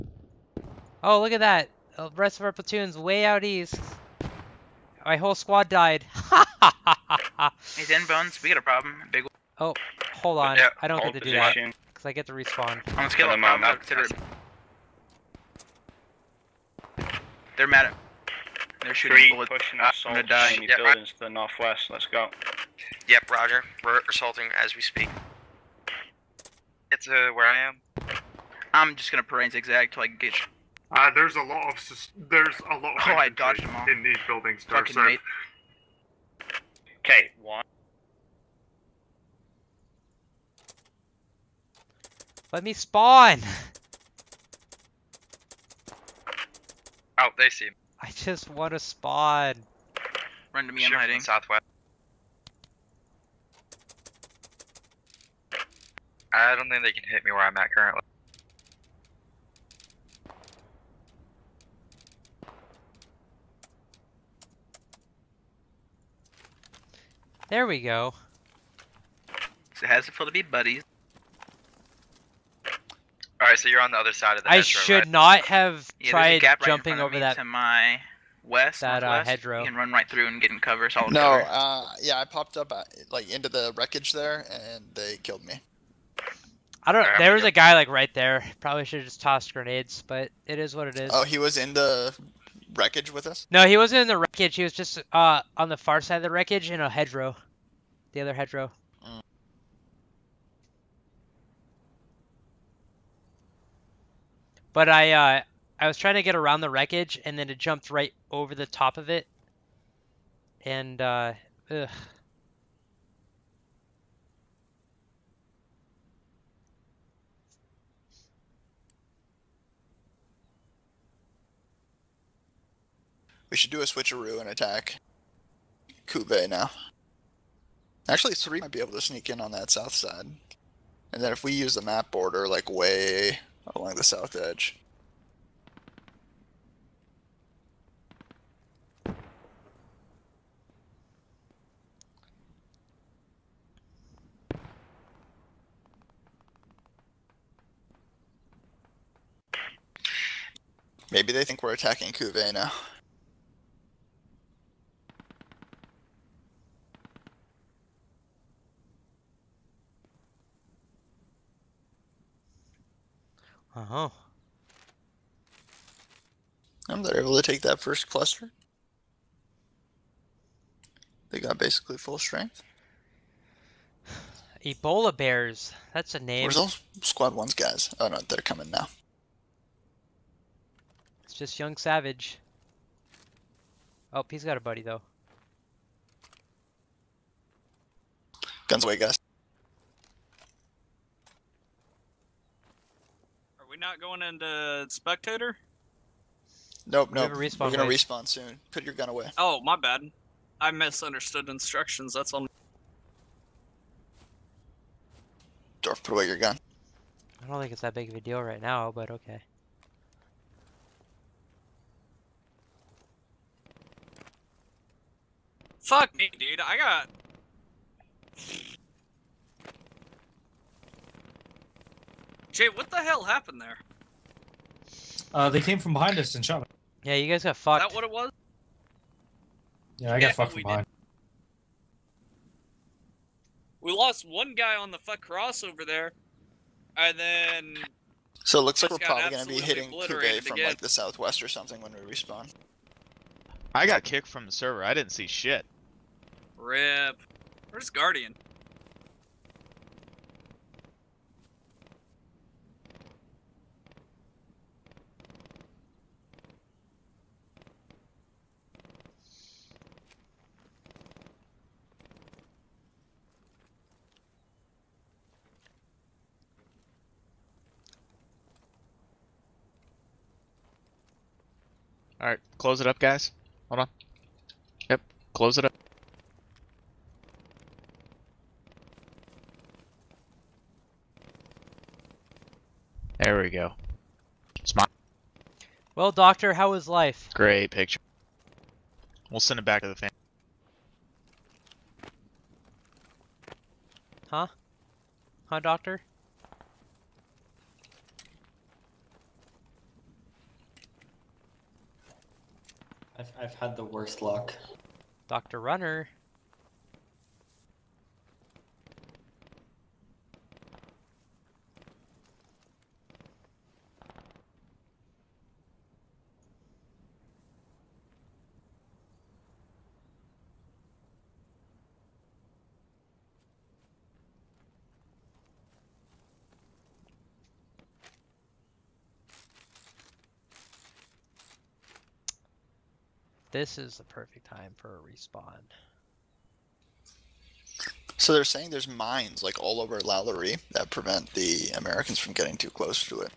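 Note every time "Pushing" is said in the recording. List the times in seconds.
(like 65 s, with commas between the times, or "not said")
19 s.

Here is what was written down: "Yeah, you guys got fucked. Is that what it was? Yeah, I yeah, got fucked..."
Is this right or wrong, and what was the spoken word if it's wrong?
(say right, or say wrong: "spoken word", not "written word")
right.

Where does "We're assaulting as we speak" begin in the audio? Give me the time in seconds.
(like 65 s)
23 s.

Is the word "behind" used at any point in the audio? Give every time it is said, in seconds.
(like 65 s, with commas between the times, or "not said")
225 s, 230 s.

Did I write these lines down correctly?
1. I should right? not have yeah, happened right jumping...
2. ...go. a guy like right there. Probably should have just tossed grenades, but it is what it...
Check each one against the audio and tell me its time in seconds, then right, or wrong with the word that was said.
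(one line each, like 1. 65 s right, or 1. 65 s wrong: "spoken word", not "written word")
1. 74 s wrong: "tried", not "happened"
2. 87 s right.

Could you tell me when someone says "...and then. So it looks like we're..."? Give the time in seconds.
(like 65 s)
236 s.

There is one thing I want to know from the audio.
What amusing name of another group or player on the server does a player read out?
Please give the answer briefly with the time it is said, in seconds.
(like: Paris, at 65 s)
Ebola Bears, at 174 s.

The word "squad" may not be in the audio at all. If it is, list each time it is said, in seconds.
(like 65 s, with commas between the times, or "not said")
5 s, 177 s.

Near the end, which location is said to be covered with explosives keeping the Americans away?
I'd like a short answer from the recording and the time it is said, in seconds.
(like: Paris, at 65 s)
Lalaurie, at 339 s.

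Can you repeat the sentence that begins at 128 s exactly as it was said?
Actually, three might be able to sneak in on that south side.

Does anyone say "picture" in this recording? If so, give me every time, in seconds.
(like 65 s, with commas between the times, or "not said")
287 s.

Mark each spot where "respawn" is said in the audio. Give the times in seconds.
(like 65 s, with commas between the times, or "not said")
12 s, 197 s, 242 s, 334 s.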